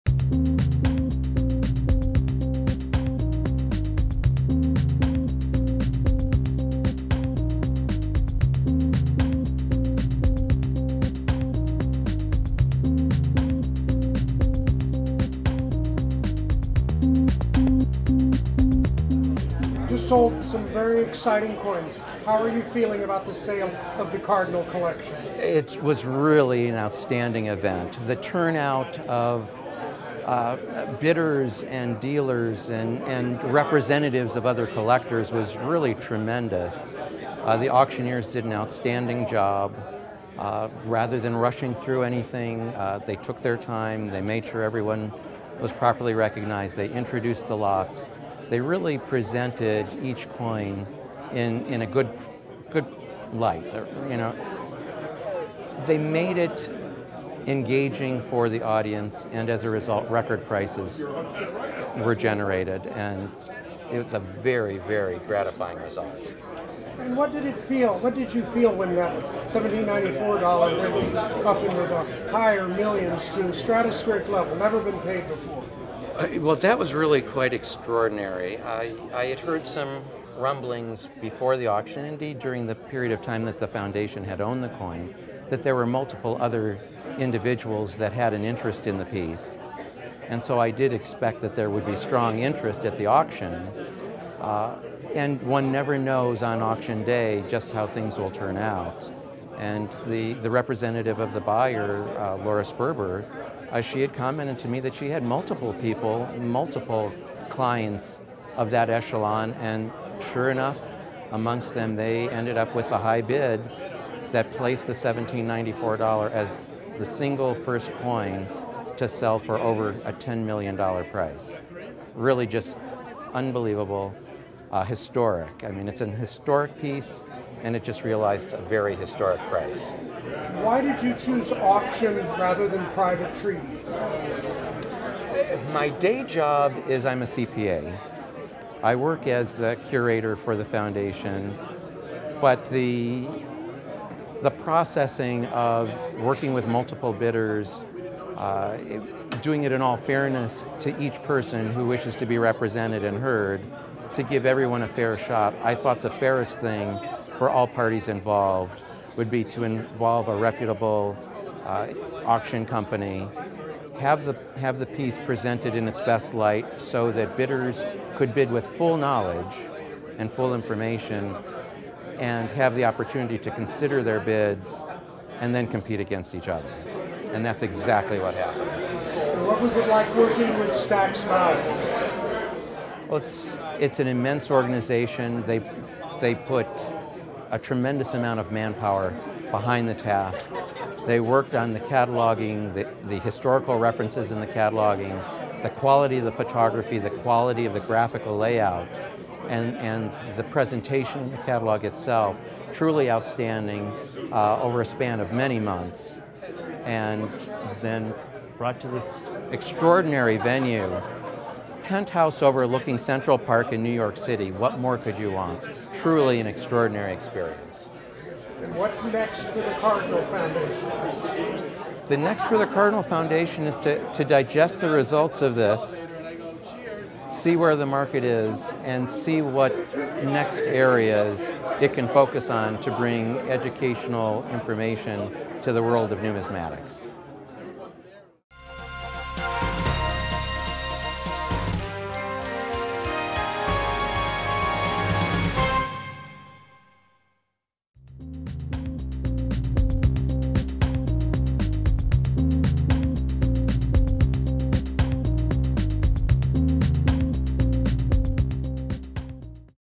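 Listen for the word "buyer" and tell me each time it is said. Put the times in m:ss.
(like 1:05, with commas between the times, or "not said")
1:41.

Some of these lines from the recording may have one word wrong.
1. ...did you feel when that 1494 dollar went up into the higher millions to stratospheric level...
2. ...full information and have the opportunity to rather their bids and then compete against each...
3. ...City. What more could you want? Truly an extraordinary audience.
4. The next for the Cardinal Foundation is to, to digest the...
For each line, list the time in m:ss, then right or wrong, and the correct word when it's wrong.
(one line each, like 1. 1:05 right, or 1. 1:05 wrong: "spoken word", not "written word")
1. 1:08 wrong: "1794", not "1494"
2. 2:50 wrong: "consider", not "rather"
3. 3:34 wrong: "experience", not "audience"
4. 3:42 right.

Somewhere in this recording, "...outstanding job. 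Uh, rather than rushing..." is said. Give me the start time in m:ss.
0:38.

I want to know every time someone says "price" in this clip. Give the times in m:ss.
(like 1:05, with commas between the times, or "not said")
1:00, 2:01, 2:09.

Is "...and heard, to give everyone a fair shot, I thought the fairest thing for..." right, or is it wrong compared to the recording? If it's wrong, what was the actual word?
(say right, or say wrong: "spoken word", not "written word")
right.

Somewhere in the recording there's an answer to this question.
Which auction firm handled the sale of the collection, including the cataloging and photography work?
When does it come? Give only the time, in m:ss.
3:00.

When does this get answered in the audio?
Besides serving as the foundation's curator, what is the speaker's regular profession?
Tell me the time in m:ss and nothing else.
2:17.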